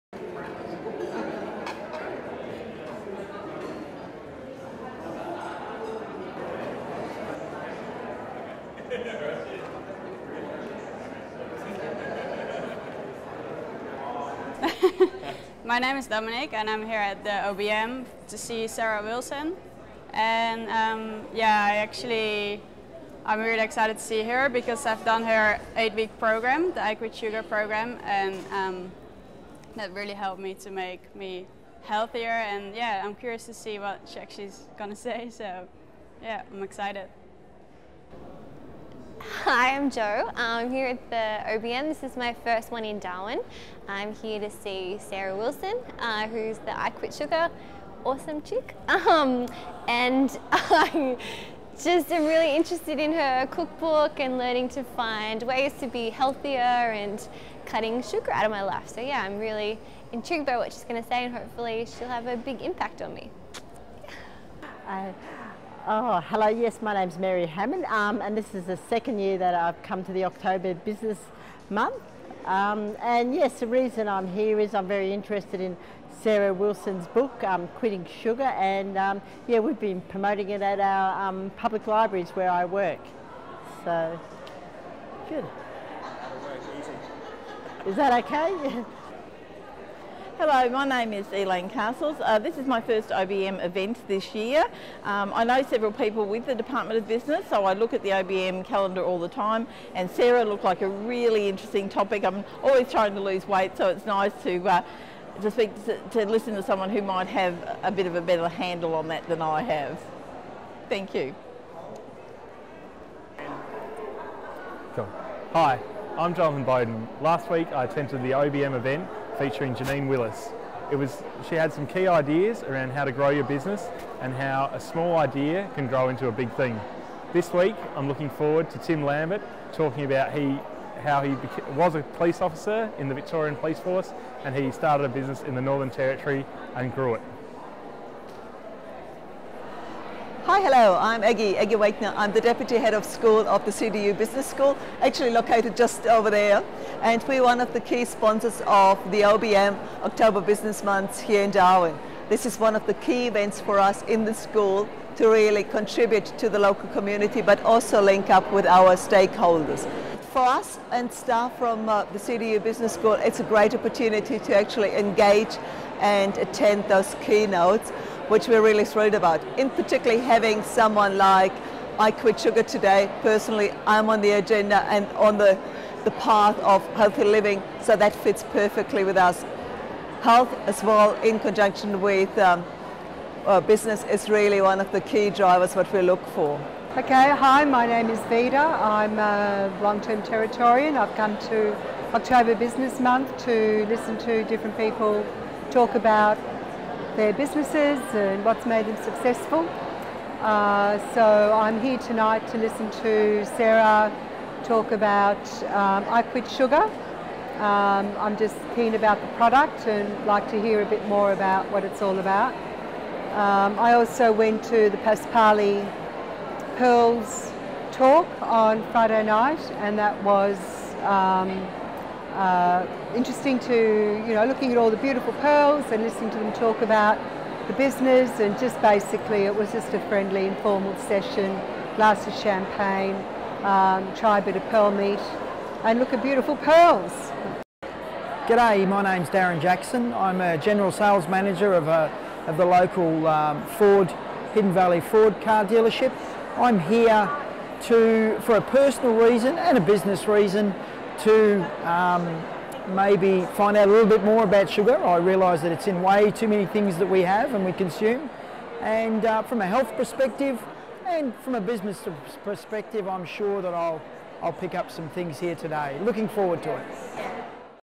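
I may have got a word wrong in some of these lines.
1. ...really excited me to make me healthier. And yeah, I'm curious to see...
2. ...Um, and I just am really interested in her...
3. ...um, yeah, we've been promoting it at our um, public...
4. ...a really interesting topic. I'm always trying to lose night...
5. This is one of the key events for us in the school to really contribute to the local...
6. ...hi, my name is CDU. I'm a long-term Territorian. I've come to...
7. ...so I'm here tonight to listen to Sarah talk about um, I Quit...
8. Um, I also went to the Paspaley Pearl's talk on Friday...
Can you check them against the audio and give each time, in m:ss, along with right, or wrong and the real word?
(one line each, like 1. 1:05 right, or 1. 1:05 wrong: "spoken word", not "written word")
1. 0:29 wrong: "helped", not "excited"
2. 0:48 right
3. 1:18 right
4. 1:40 wrong: "weight", not "night"
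5. 2:32 right
6. 3:07 wrong: "Vida", not "CDU"
7. 3:21 right
8. 3:33 right.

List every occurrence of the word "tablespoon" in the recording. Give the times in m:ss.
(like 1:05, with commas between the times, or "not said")
not said.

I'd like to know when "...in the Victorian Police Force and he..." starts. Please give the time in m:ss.
2:12.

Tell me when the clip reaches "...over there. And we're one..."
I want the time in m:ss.
2:26.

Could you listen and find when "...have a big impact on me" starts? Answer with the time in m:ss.
1:02.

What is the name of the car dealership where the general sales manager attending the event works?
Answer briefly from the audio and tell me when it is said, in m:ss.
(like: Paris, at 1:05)
Hidden Valley Ford, at 4:04.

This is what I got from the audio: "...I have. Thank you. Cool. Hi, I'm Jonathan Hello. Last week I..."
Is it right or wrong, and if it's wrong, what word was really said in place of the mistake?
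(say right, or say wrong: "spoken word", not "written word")
wrong: "Bowden", not "Hello".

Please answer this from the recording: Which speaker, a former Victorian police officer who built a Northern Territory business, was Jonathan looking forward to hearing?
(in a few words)
Tim Lambert.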